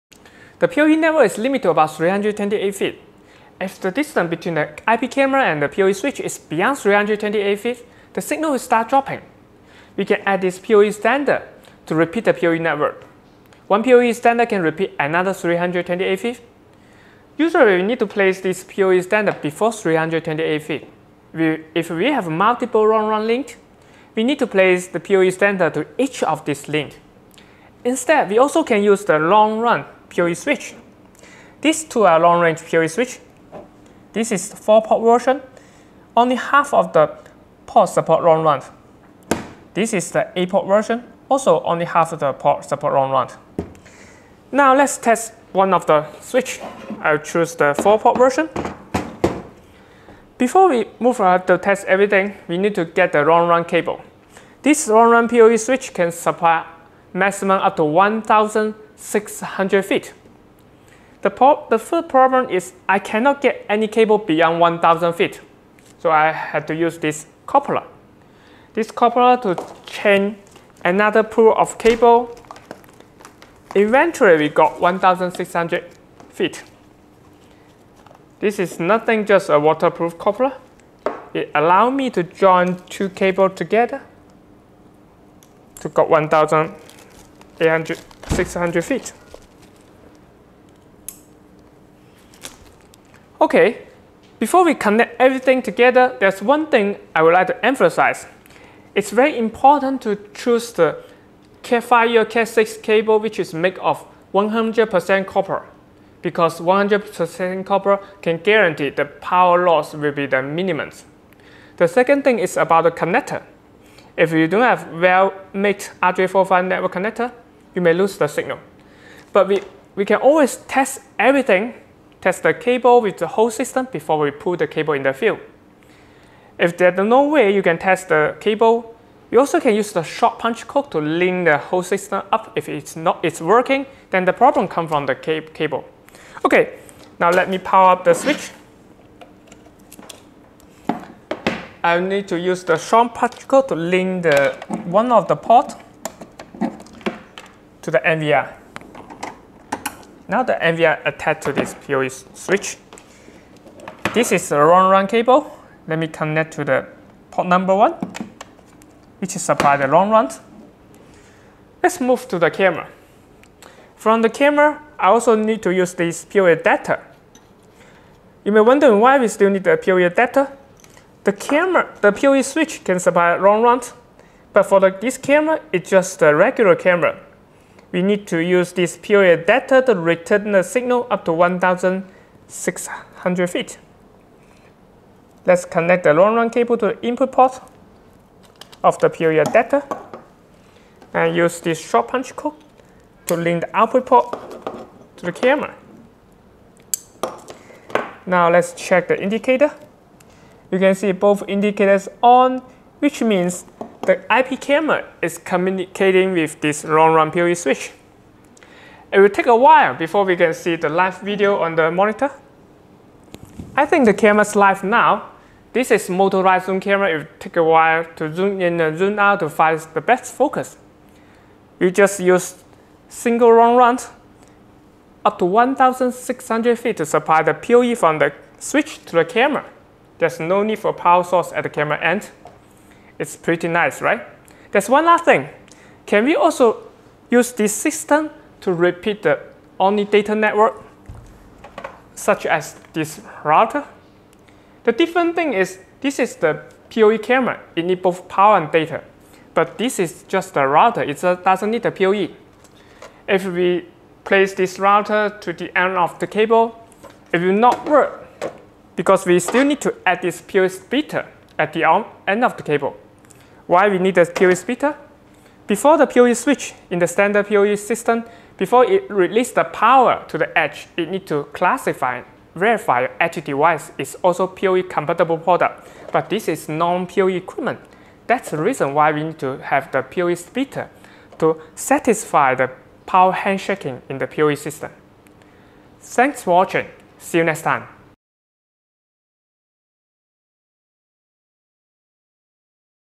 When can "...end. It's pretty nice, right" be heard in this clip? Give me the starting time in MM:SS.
03:51.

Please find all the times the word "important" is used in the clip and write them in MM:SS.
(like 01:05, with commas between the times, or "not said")
01:39.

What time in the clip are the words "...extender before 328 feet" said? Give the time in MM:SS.
00:19.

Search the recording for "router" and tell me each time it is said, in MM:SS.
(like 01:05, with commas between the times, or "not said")
04:03, 04:10, 04:14.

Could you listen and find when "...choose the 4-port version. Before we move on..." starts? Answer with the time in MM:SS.
00:47.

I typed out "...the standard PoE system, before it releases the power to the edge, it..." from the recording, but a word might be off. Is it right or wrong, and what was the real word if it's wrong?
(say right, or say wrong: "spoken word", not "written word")
right.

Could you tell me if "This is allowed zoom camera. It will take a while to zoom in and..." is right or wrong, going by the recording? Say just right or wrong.
wrong.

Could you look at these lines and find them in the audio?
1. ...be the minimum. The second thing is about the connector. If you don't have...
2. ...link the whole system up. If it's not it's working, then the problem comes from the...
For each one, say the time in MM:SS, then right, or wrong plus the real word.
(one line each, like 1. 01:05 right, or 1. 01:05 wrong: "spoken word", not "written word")
1. 01:50 right
2. 02:10 right.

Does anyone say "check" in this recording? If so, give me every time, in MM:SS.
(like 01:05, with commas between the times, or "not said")
03:18.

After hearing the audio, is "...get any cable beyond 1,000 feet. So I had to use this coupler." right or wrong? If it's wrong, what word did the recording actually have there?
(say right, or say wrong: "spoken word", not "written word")
right.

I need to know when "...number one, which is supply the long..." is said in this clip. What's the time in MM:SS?
02:37.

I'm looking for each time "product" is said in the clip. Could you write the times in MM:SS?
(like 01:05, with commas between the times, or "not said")
04:35.